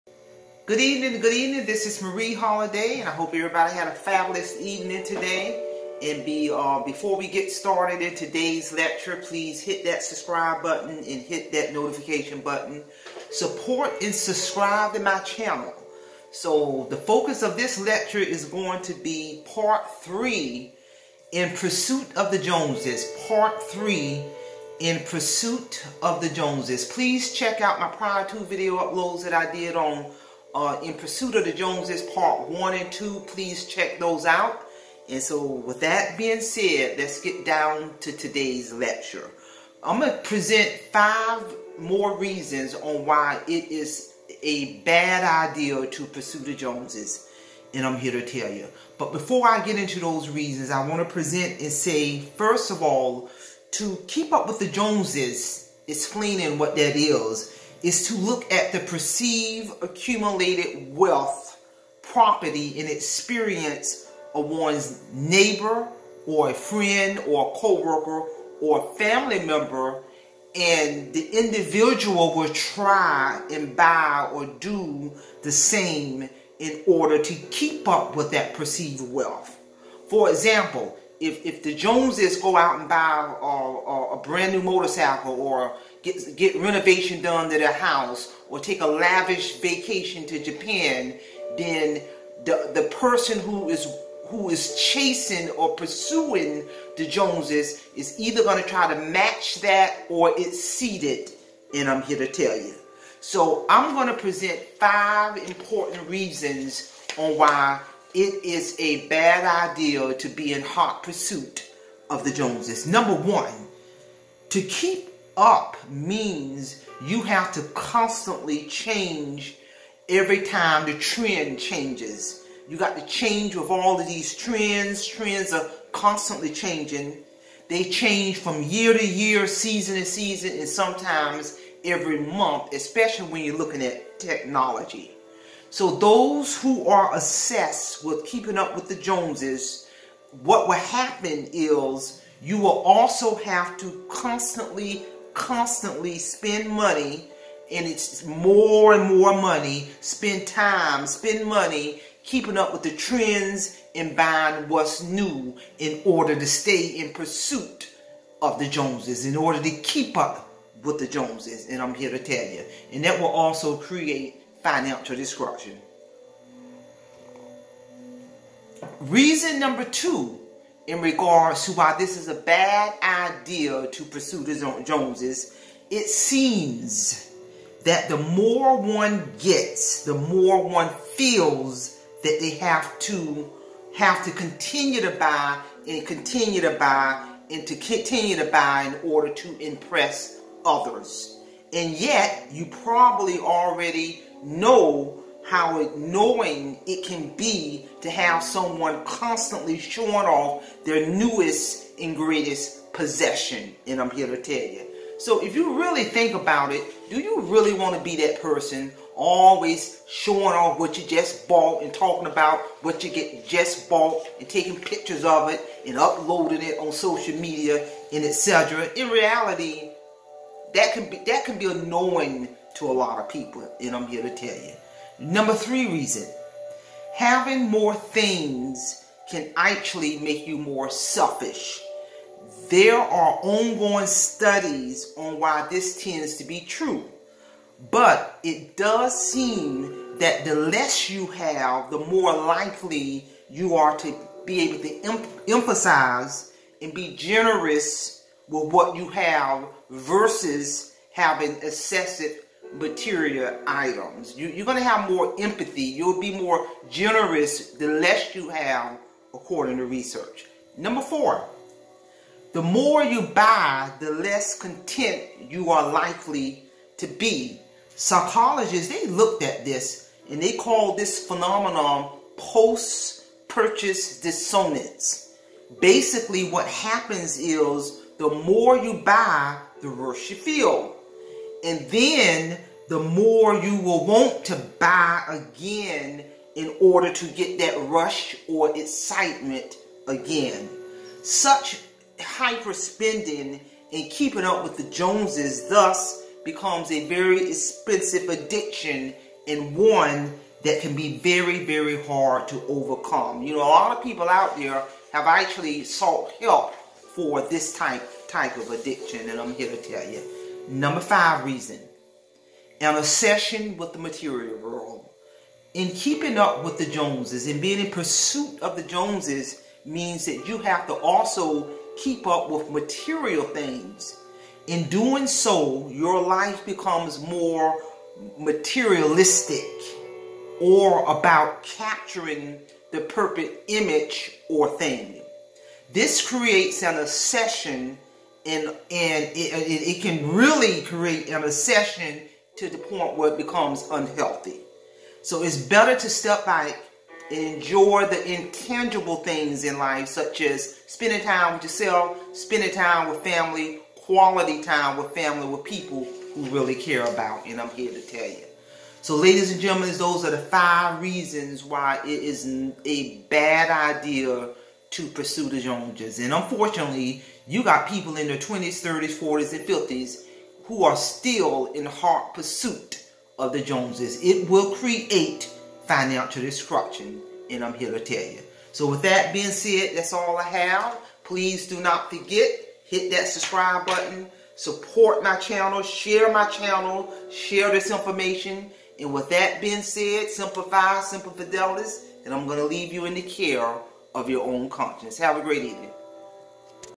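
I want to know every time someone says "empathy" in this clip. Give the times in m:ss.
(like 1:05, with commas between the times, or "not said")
4:15.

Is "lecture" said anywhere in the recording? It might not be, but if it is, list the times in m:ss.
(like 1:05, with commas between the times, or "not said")
0:08, 0:17, 0:38.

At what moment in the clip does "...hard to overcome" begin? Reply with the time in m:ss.
5:02.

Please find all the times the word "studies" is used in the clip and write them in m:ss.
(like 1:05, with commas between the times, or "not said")
3:54.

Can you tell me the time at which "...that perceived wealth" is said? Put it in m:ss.
1:18.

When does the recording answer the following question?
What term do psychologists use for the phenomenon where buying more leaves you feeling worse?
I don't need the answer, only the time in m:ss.
4:32.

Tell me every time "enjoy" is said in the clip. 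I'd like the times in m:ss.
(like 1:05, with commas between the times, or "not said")
5:47.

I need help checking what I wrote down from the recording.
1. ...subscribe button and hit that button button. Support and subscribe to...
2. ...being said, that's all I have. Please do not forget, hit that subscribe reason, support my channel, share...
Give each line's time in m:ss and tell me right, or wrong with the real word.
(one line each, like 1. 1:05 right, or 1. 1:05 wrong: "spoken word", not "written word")
1. 0:10 wrong: "notification", not "button"
2. 6:19 wrong: "button", not "reason".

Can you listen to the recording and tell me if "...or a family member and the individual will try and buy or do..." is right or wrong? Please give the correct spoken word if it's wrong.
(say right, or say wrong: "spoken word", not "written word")
right.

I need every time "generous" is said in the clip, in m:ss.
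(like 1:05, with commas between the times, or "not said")
4:07, 4:16.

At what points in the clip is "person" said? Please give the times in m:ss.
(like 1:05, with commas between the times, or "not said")
1:32, 3:28.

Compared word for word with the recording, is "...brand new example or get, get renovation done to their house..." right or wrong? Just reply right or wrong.
wrong.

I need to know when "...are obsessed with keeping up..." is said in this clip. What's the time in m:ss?
2:16.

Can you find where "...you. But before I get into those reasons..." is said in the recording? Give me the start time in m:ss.
0:48.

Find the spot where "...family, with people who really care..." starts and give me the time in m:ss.
5:55.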